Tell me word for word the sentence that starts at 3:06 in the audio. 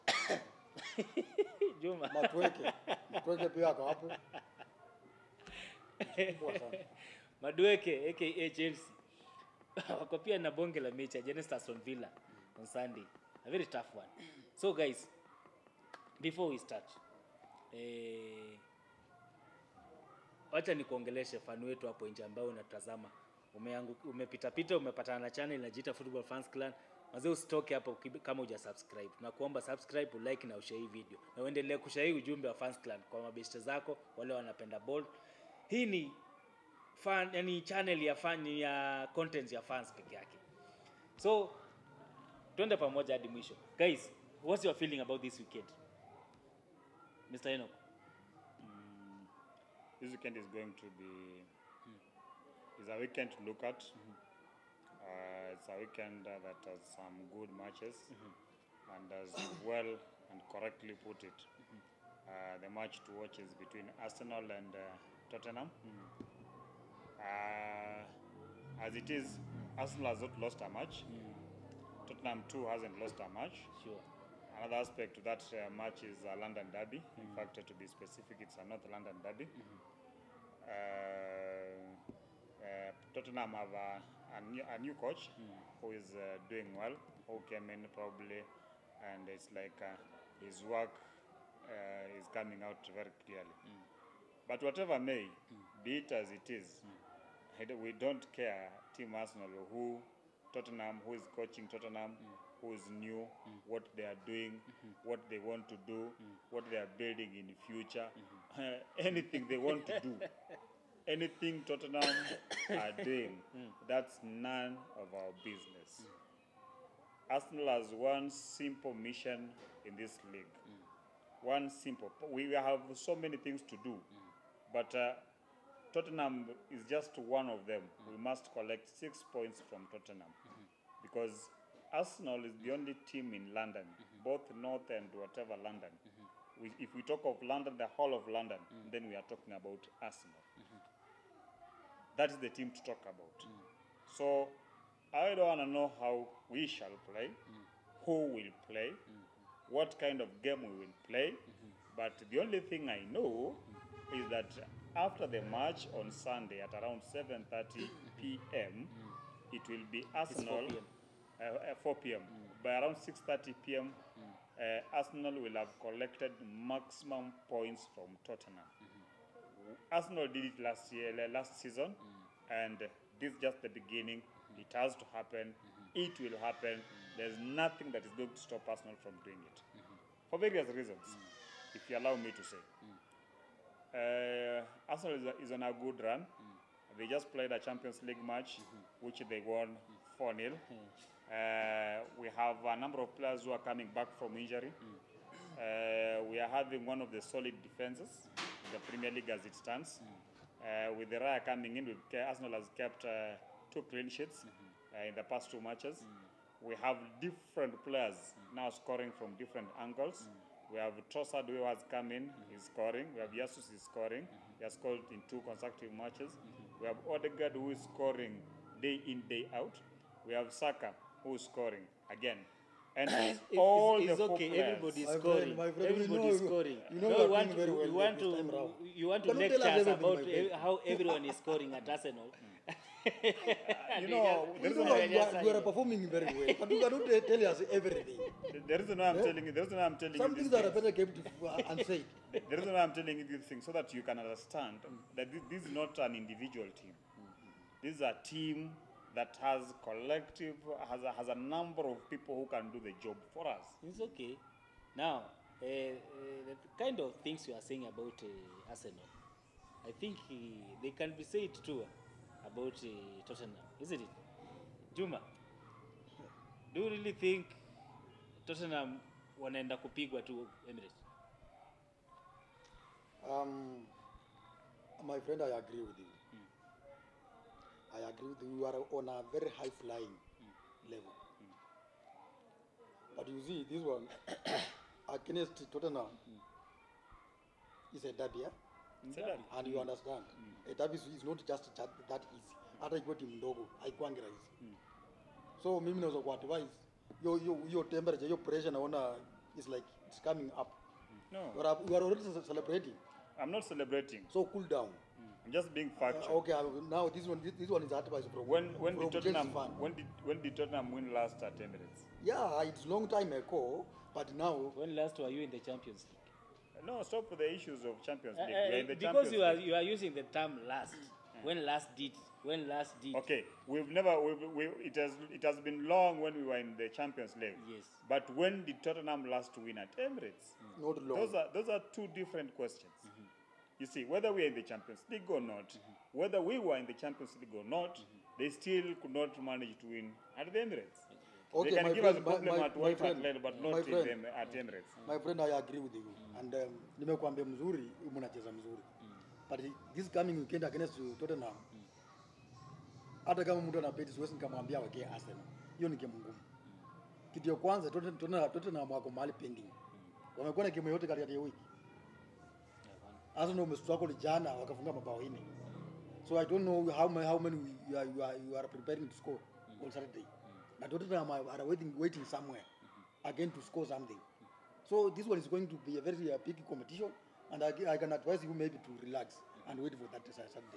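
They just played a Champions League match, mm -hmm.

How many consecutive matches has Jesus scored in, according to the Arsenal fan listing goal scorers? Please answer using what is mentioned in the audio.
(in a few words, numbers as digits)
2.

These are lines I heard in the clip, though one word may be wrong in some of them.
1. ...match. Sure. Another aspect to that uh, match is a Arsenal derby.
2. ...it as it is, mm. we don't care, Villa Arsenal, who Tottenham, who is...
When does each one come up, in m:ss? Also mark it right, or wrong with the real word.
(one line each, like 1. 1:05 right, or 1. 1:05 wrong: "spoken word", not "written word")
1. 1:13 wrong: "London", not "Arsenal"
2. 1:36 wrong: "Team", not "Villa".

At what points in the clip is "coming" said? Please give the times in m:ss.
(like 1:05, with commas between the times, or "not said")
1:32, 3:13, 3:21, 5:00, 5:50.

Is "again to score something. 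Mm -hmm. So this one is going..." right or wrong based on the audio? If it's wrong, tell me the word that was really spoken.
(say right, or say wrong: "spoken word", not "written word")
right.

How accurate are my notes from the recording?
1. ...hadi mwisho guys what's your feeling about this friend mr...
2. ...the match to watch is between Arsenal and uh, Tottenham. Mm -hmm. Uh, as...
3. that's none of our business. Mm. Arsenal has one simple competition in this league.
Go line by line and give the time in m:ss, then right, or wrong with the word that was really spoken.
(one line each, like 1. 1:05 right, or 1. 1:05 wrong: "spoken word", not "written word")
1. 0:43 wrong: "weekend", not "friend"
2. 1:02 right
3. 1:53 wrong: "mission", not "competition".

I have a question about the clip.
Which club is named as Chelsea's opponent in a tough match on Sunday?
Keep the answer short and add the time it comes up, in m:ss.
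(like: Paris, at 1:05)
Aston Villa, at 0:11.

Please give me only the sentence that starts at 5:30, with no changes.
not long those are those are two different questions mm.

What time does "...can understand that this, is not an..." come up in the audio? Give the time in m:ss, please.
4:04.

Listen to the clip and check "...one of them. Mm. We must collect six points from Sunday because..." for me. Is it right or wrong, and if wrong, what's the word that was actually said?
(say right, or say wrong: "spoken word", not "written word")
wrong: "Tottenham", not "Sunday".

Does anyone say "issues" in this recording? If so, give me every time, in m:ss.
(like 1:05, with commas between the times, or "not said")
5:17.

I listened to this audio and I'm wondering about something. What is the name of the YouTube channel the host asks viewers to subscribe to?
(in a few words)
Football Fans Clan.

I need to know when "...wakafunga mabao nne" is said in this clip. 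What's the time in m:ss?
6:04.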